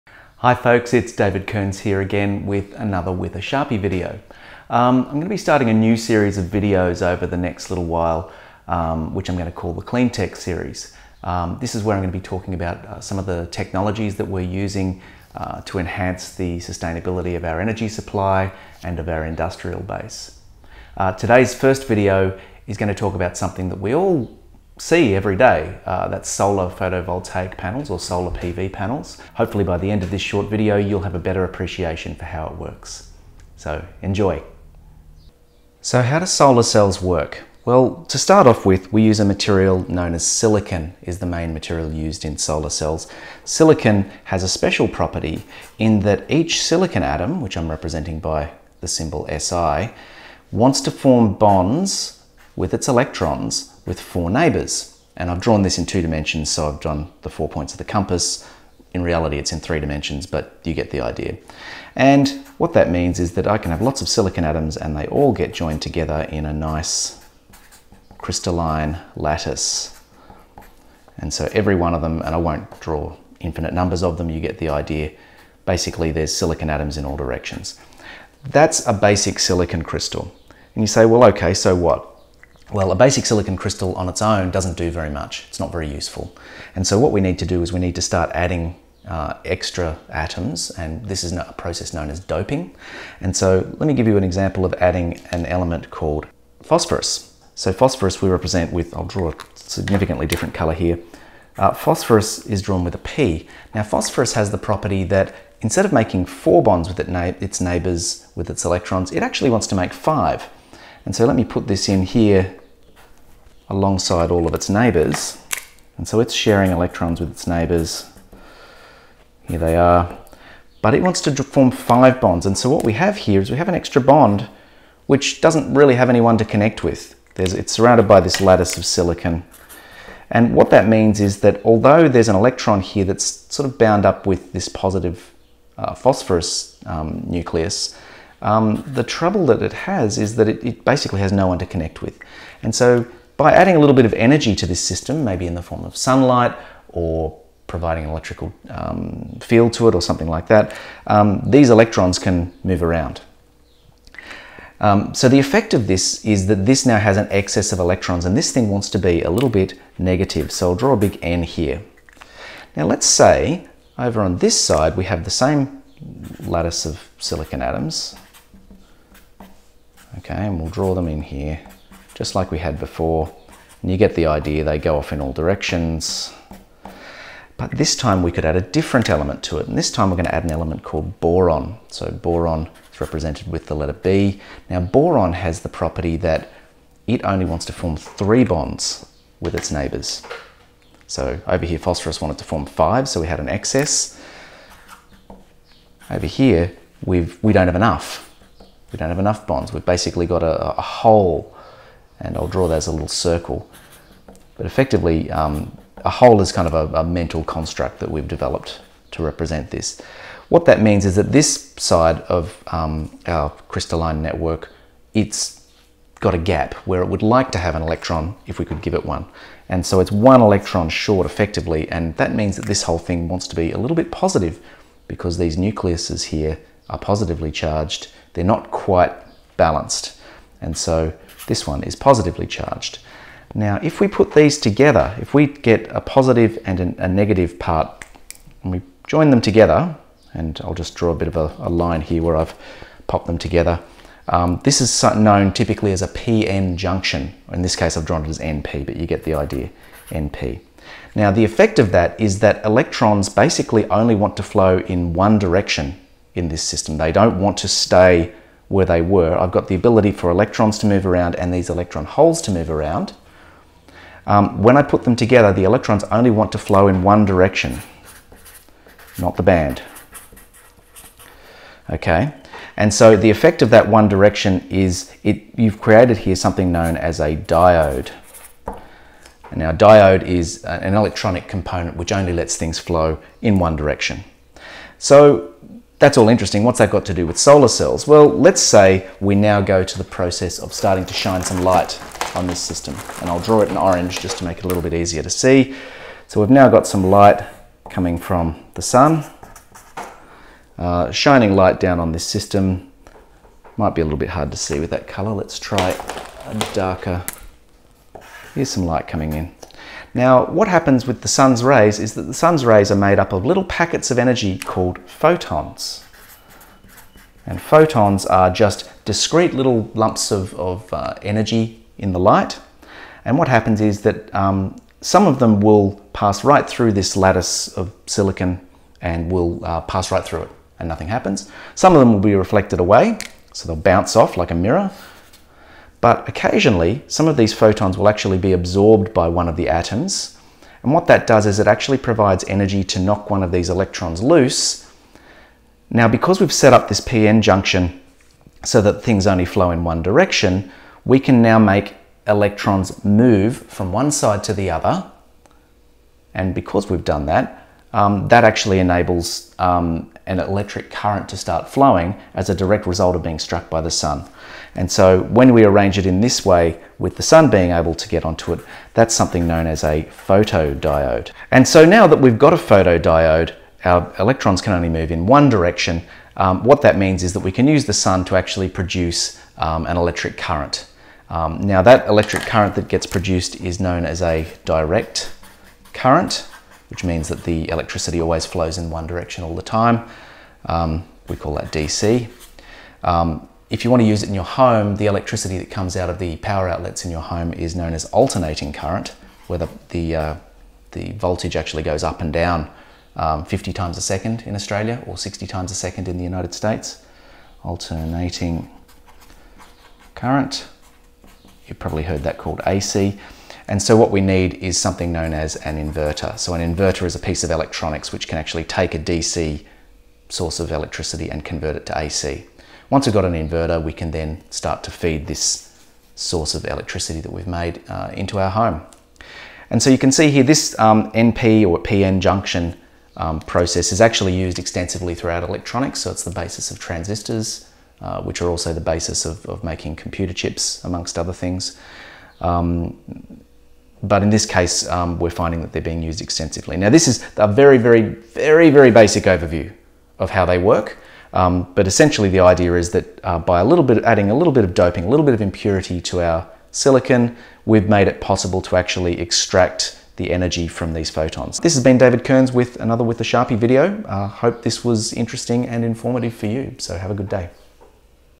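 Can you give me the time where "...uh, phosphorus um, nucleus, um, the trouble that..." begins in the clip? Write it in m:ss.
2:15.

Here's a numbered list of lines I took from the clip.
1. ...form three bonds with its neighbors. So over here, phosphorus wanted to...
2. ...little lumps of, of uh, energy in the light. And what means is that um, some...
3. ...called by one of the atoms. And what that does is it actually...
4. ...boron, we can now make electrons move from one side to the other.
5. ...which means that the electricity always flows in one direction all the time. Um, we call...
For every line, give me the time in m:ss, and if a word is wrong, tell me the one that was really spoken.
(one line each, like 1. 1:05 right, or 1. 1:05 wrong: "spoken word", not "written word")
1. 3:07 right
2. 5:19 wrong: "happens", not "means"
3. 5:38 wrong: "absorbed", not "called"
4. 5:50 wrong: "direction", not "boron"
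5. 6:26 right.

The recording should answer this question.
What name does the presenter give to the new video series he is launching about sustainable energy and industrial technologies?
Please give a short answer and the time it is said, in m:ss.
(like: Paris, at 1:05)
Clean Tech series, at 0:09.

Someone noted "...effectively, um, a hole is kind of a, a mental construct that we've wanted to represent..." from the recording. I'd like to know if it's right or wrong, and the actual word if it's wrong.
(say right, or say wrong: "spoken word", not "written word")
wrong: "developed", not "wanted".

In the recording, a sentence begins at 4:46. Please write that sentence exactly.
What's that got to do with solar cells?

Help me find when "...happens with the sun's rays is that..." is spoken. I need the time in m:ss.
5:10.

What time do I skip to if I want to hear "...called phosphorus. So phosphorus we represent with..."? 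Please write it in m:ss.
1:35.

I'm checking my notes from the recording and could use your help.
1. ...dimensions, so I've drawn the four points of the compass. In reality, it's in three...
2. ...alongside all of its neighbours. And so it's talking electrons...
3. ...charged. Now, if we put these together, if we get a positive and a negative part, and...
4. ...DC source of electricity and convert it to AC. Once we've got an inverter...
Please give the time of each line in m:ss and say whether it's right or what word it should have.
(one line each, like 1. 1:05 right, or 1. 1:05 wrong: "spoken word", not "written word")
1. 0:56 right
2. 1:53 wrong: "sharing", not "talking"
3. 3:52 right
4. 6:58 right.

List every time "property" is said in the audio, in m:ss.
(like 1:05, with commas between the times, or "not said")
0:44, 1:44, 3:05.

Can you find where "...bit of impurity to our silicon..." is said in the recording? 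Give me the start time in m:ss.
7:35.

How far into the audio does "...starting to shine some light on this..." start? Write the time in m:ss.
4:50.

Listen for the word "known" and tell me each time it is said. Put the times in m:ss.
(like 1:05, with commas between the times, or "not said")
0:39, 1:31, 4:05, 4:36, 6:09, 6:23, 6:37, 6:55.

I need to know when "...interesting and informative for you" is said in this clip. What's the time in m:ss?
7:45.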